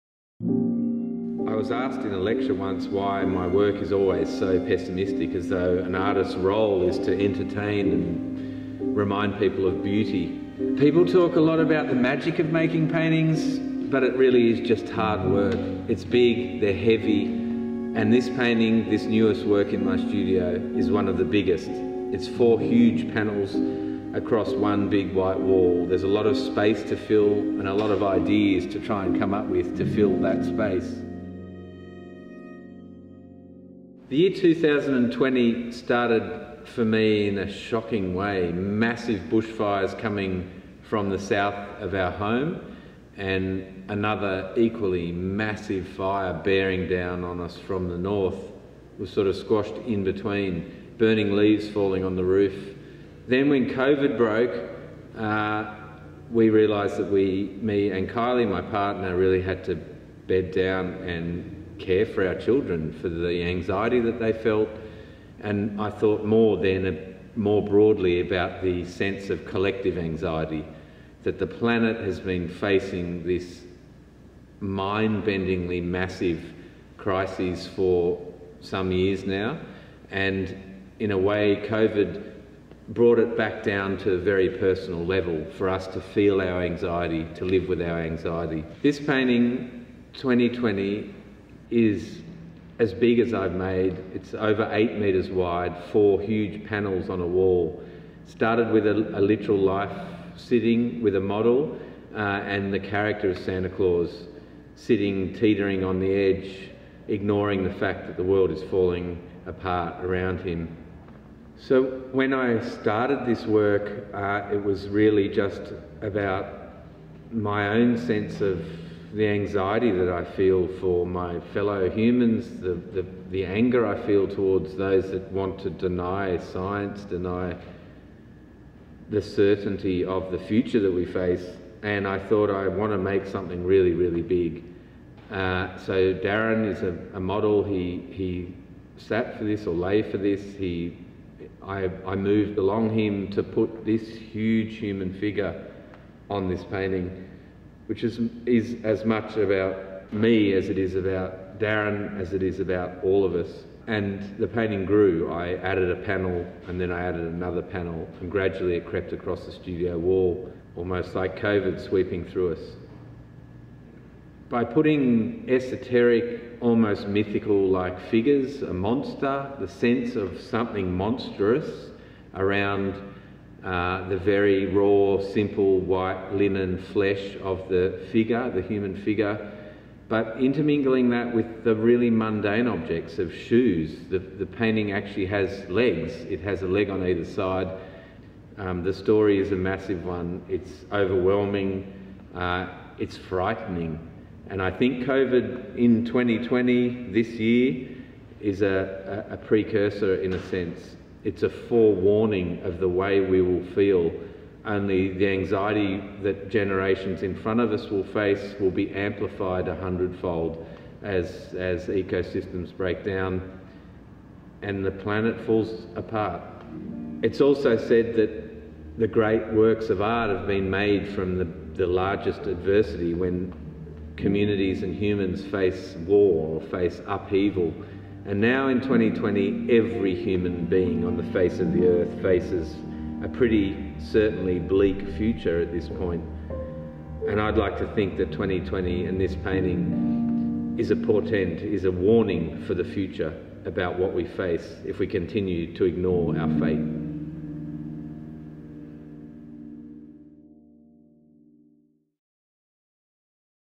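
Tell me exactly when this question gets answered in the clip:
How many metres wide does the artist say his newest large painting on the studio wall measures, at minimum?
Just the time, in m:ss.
1:34.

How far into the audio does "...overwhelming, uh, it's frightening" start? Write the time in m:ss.
3:10.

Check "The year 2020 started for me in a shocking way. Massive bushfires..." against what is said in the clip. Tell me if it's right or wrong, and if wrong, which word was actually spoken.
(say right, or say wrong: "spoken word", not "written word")
right.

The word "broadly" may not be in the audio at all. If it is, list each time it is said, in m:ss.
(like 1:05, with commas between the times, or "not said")
1:07.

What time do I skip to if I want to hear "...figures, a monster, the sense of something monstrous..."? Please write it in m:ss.
2:48.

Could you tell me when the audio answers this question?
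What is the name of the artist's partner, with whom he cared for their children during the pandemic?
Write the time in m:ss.
0:58.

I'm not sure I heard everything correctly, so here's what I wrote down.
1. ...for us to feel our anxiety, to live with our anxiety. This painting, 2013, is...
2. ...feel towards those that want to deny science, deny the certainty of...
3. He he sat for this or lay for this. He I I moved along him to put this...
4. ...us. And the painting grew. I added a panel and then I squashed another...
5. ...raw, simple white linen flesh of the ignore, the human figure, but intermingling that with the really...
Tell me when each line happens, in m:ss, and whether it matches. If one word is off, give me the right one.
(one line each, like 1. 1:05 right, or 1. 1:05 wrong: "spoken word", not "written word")
1. 1:25 wrong: "2020", not "2013"
2. 2:04 right
3. 2:17 right
4. 2:33 wrong: "added", not "squashed"
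5. 2:54 wrong: "figure", not "ignore".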